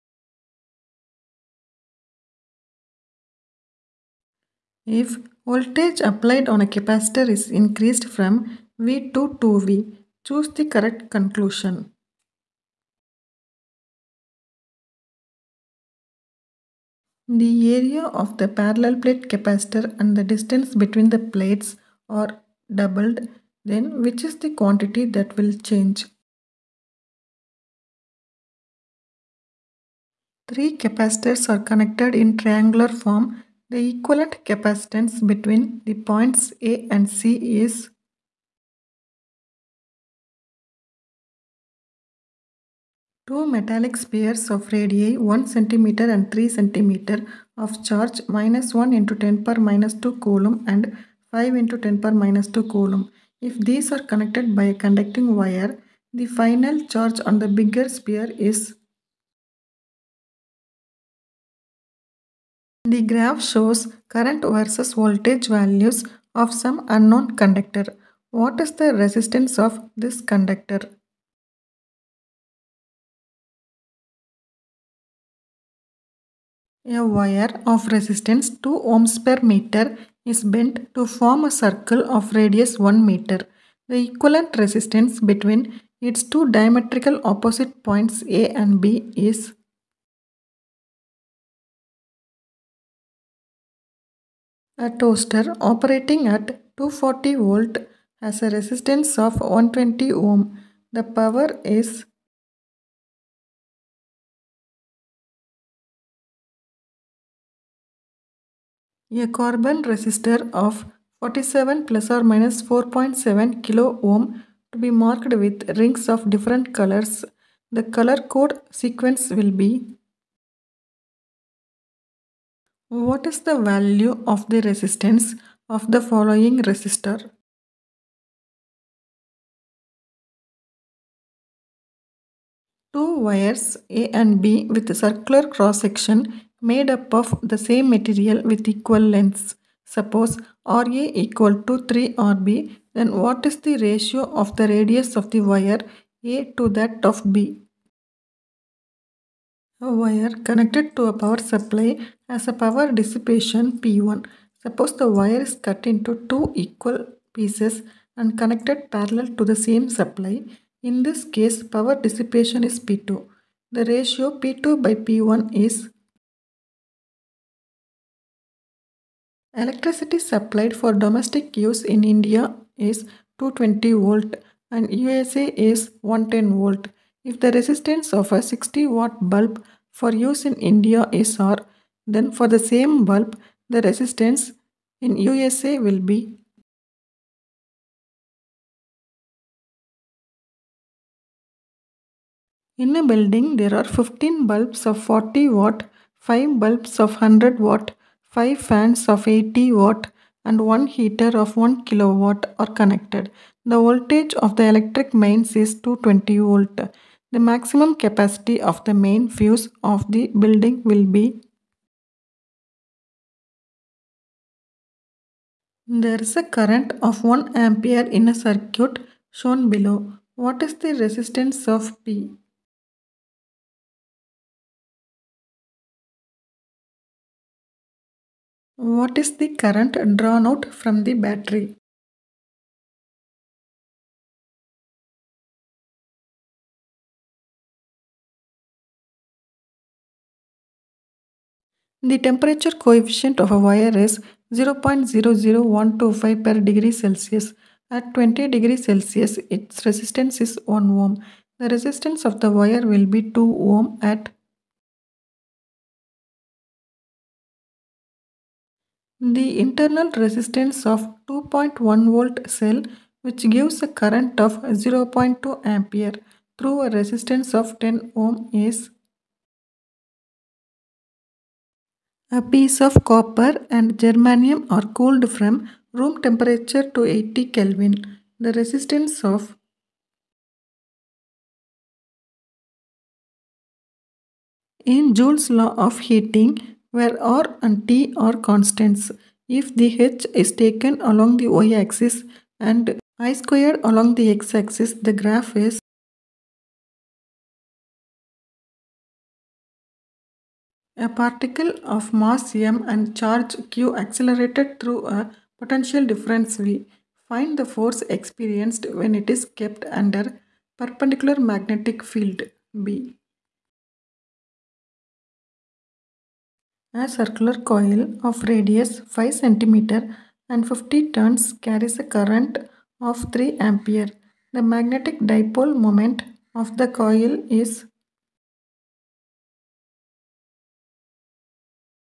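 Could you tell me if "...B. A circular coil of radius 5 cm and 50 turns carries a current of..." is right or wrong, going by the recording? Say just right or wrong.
right.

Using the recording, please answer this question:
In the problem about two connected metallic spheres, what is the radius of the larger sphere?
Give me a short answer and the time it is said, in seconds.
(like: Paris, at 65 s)
3 cm, at 46 s.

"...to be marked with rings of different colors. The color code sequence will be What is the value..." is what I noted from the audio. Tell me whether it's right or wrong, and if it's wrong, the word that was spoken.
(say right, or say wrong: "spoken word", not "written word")
right.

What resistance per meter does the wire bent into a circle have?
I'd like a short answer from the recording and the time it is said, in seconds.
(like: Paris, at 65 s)
2 ohms per meter, at 78 s.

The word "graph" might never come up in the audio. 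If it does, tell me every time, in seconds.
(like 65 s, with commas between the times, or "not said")
63 s, 295 s.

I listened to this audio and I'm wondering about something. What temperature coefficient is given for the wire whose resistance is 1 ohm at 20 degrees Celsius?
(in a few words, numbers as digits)
0.00125 per degree Celsius.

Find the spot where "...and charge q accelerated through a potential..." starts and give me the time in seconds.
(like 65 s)
302 s.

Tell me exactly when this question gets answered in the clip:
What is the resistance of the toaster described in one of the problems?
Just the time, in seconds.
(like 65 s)
99 s.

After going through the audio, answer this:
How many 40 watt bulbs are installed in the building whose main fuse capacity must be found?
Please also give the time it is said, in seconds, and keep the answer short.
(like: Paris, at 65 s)
15, at 193 s.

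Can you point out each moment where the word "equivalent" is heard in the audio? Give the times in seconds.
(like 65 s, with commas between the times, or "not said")
33 s, 84 s.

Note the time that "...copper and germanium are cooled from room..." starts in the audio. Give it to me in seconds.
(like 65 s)
273 s.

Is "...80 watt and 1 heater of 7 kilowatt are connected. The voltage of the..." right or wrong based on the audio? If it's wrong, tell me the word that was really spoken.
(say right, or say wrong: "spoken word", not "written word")
wrong: "1", not "7".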